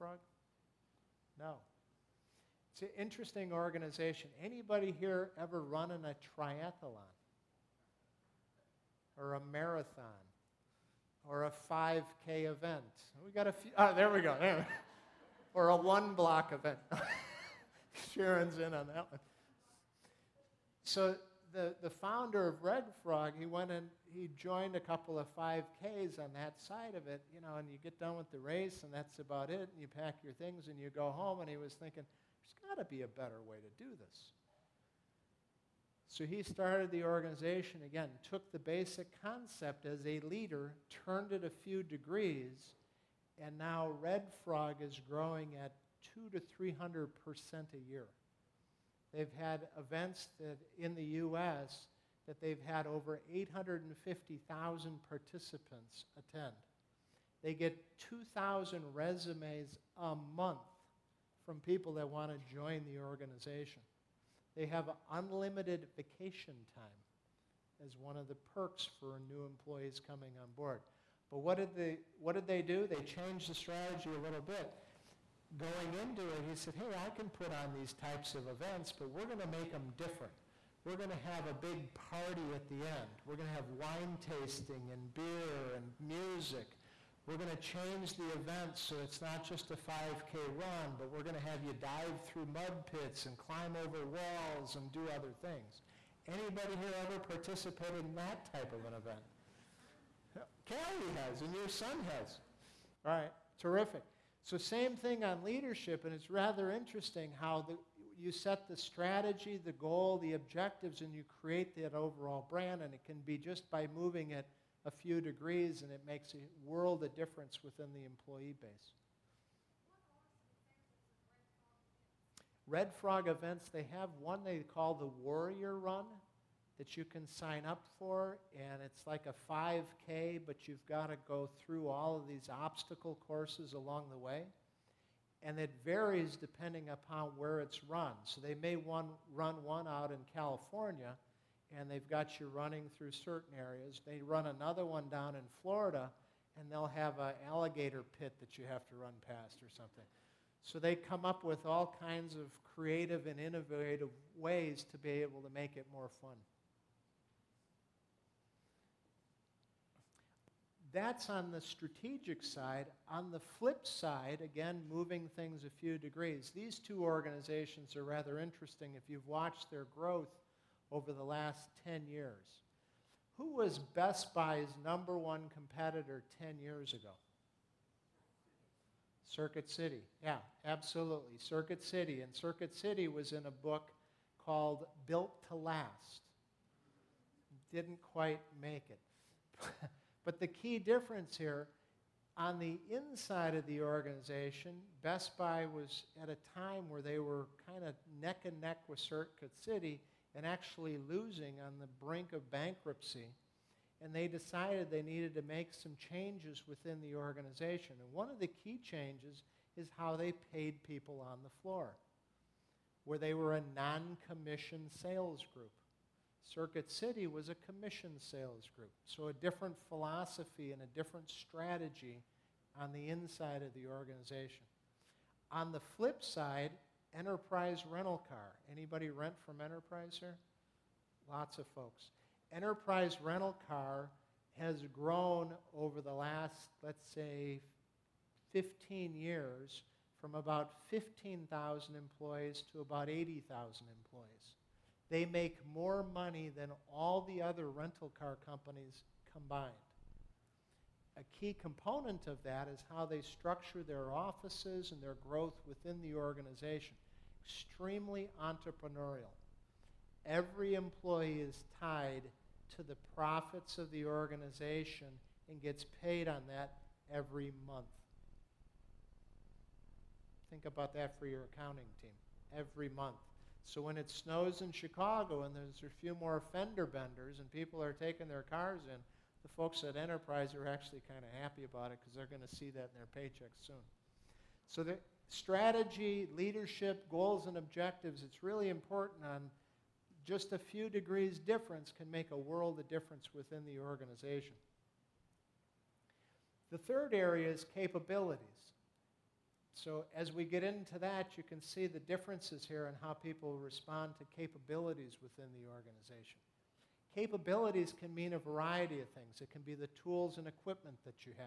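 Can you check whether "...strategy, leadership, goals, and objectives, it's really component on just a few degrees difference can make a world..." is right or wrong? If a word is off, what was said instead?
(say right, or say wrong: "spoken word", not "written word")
wrong: "important", not "component".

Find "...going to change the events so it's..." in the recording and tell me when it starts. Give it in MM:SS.
01:27.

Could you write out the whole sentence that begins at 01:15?
Going into it, he said, Hey, I can put on these types of events, but we're going to make them different.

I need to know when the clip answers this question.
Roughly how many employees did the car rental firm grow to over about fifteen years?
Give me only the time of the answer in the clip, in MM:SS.
04:03.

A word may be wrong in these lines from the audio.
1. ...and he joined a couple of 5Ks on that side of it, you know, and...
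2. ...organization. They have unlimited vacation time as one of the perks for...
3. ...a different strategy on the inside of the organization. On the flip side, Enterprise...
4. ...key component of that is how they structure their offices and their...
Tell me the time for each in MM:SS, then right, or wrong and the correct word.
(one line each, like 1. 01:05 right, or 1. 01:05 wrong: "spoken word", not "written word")
1. 00:23 right
2. 01:03 right
3. 03:40 right
4. 04:11 right.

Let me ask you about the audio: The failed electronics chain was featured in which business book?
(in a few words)
Built to Last.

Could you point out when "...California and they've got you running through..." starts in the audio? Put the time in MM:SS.
02:20.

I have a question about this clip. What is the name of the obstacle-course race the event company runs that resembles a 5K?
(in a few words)
Warrior Run.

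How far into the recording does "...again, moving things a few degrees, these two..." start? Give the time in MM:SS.
02:44.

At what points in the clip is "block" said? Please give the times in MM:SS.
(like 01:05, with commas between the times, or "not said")
00:16.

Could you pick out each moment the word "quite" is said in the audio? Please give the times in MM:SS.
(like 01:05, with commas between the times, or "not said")
03:08.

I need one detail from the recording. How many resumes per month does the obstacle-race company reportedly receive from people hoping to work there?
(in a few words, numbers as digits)
2,000.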